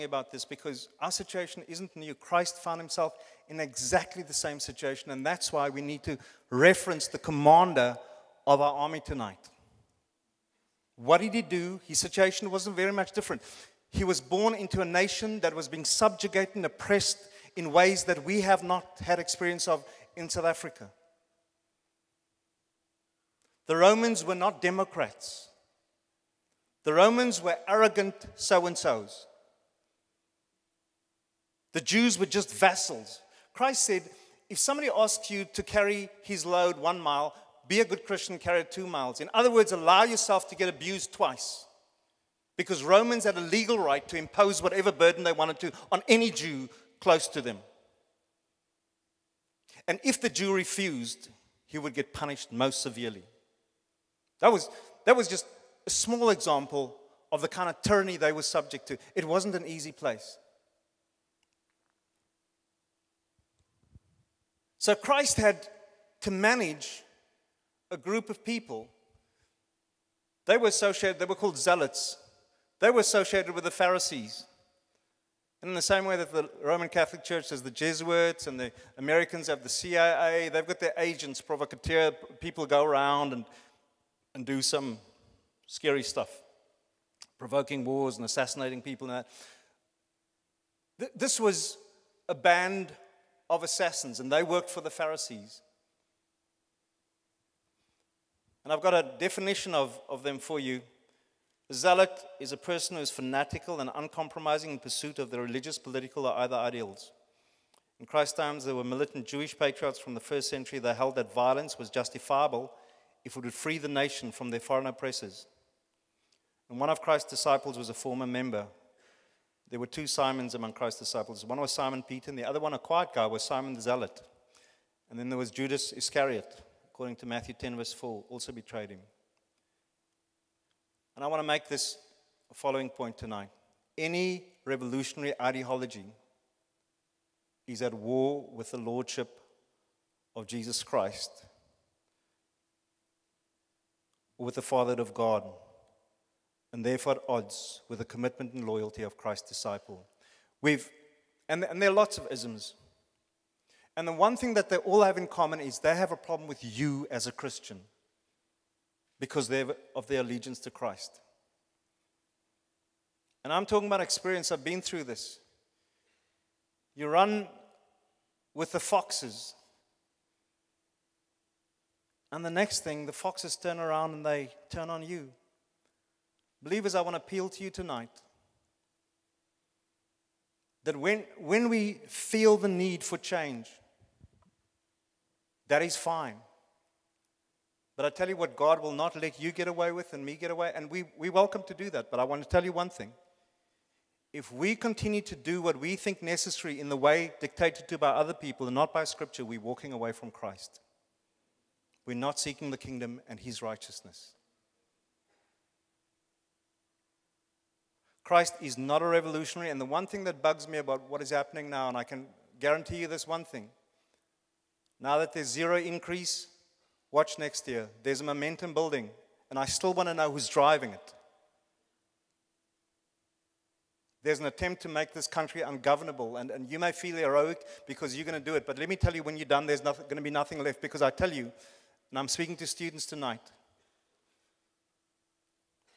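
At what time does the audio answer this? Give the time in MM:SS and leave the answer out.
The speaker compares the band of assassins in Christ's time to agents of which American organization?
01:19.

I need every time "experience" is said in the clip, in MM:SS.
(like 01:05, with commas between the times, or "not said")
00:19, 02:43.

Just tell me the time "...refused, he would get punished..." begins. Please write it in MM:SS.
00:50.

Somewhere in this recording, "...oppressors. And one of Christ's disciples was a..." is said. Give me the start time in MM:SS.
01:54.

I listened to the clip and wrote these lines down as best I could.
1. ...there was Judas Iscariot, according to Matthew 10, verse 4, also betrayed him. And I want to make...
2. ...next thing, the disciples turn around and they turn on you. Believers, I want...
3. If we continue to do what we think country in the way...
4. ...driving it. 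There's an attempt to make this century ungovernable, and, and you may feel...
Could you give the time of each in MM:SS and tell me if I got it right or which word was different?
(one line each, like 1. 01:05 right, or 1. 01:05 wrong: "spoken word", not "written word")
1. 02:05 right
2. 02:52 wrong: "foxes", not "disciples"
3. 03:14 wrong: "necessary", not "country"
4. 03:40 wrong: "country", not "century".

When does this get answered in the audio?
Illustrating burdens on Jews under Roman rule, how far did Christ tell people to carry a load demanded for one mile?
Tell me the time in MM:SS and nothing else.
00:38.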